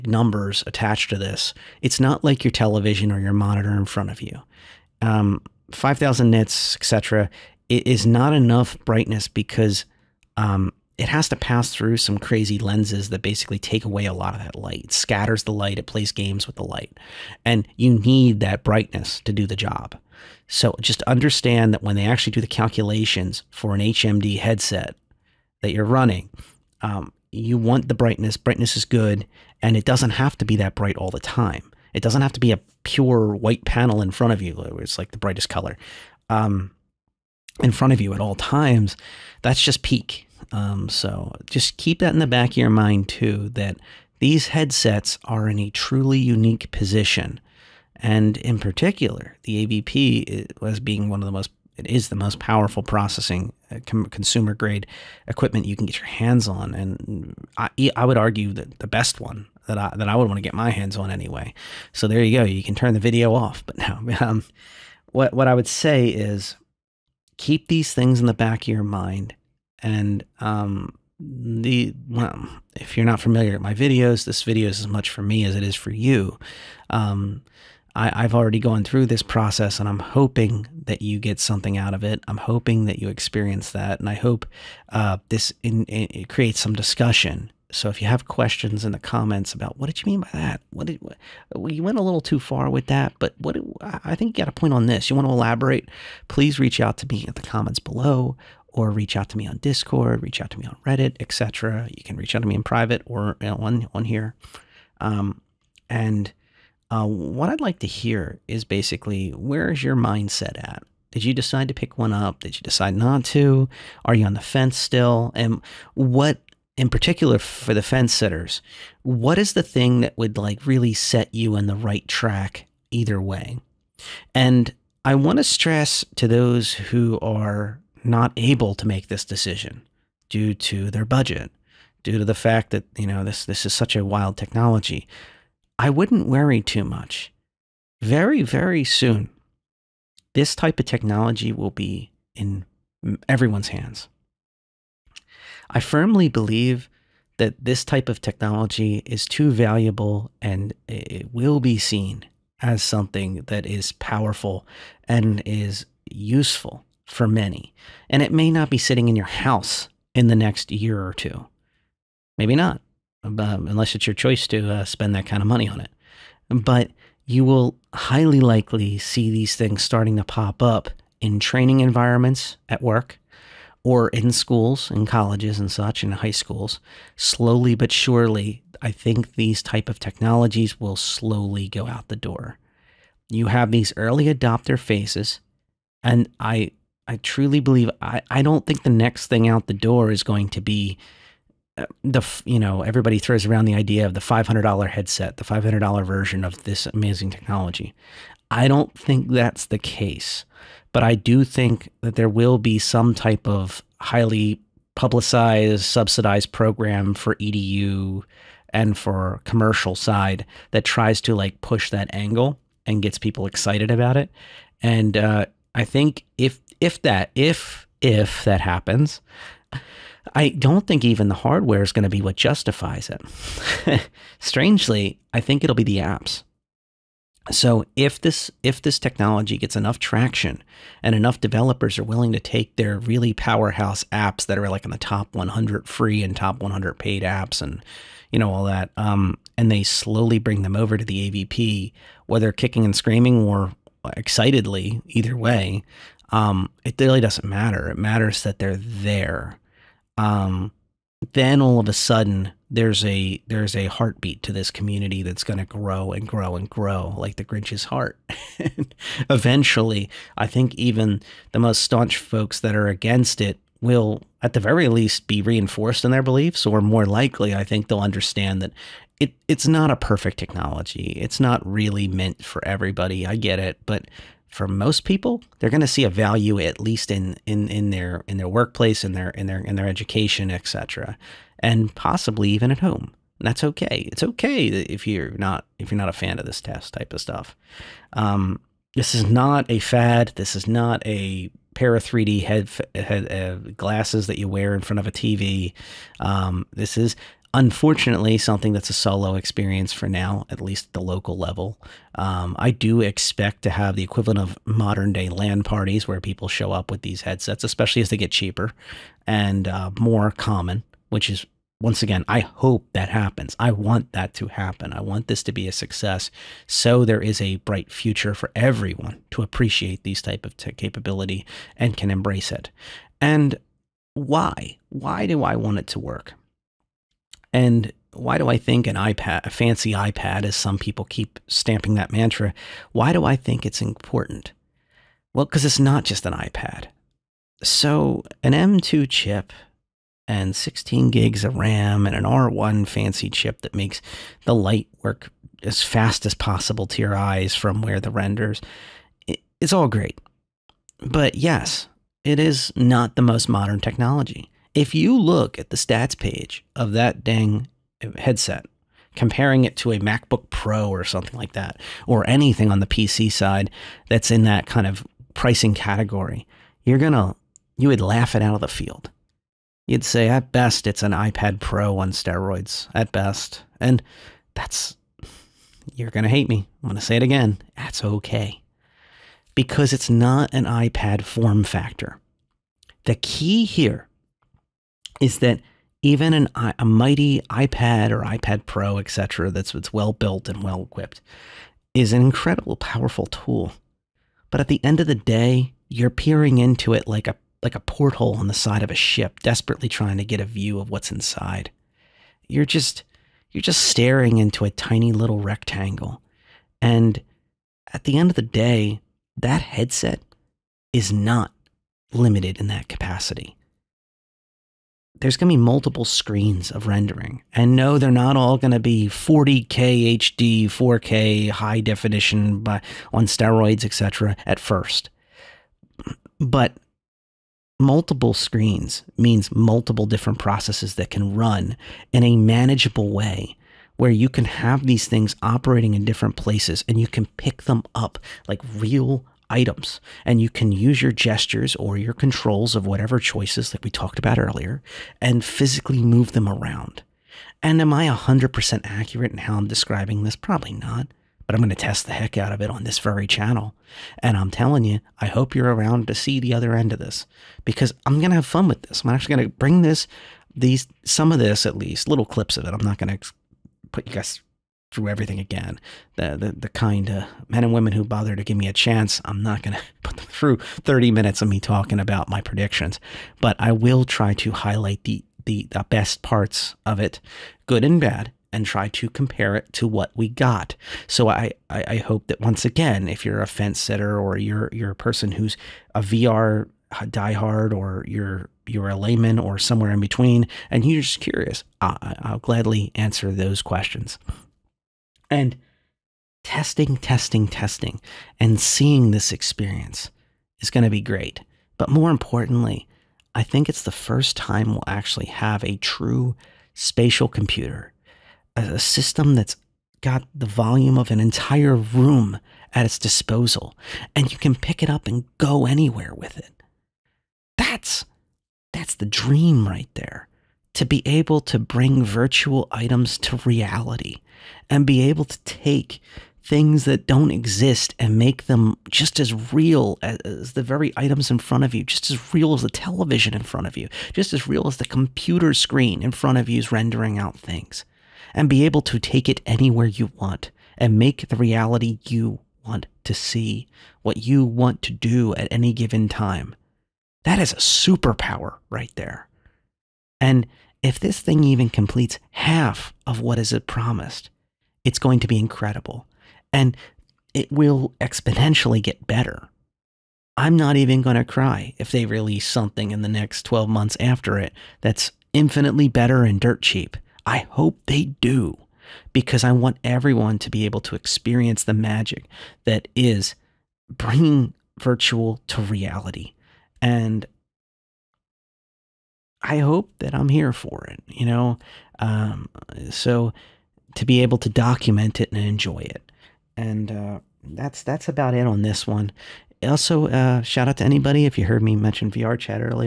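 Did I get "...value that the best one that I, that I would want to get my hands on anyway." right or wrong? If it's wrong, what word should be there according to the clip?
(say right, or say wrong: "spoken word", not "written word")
wrong: "argue", not "value".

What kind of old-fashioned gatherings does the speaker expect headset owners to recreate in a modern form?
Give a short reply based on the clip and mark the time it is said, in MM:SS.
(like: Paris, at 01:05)
LAN parties, at 05:05.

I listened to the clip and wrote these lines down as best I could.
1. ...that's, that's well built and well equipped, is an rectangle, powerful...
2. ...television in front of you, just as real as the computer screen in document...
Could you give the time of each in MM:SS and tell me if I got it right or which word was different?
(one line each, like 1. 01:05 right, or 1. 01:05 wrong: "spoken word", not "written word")
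1. 06:29 wrong: "incredible", not "rectangle"
2. 08:52 wrong: "front", not "document".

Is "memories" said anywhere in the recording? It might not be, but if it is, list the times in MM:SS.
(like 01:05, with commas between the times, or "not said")
not said.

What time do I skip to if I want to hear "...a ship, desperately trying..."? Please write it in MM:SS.
06:38.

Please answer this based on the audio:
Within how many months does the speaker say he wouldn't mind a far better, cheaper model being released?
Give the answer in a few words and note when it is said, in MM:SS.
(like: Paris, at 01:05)
12, at 09:23.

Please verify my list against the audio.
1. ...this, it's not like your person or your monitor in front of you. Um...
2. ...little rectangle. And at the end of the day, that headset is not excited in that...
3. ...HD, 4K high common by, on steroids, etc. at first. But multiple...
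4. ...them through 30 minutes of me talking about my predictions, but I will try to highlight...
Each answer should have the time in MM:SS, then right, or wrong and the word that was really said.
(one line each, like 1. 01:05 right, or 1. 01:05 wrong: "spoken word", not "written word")
1. 00:01 wrong: "television", not "person"
2. 06:45 wrong: "limited", not "excited"
3. 07:00 wrong: "definition", not "common"
4. 07:50 right.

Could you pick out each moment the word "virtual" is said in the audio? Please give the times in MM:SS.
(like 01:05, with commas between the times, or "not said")
08:42, 09:34.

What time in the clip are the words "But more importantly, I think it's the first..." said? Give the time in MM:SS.
08:21.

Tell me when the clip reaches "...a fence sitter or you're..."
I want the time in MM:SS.
08:03.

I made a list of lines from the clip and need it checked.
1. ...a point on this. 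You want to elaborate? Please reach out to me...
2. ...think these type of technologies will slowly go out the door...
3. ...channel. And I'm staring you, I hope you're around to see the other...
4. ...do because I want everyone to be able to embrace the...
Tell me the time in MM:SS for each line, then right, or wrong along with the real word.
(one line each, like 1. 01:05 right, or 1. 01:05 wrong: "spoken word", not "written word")
1. 01:34 right
2. 02:58 right
3. 07:33 wrong: "telling", not "staring"
4. 09:28 wrong: "experience", not "embrace".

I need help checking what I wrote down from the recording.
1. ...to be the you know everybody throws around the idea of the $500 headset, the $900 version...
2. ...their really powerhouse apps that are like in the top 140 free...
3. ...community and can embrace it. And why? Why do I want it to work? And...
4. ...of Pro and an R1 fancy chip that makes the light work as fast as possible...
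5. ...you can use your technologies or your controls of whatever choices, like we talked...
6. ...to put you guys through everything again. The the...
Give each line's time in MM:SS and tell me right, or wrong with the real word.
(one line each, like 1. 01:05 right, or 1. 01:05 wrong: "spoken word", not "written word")
1. 03:10 wrong: "500", not "900"
2. 03:52 wrong: "100", not "140"
3. 05:20 wrong: "capability", not "community"
4. 05:41 wrong: "RAM", not "Pro"
5. 07:20 wrong: "gestures", not "technologies"
6. 07:43 right.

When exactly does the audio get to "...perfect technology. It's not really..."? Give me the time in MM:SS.
04:29.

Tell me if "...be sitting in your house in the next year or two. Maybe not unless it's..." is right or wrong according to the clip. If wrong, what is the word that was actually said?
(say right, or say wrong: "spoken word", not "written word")
right.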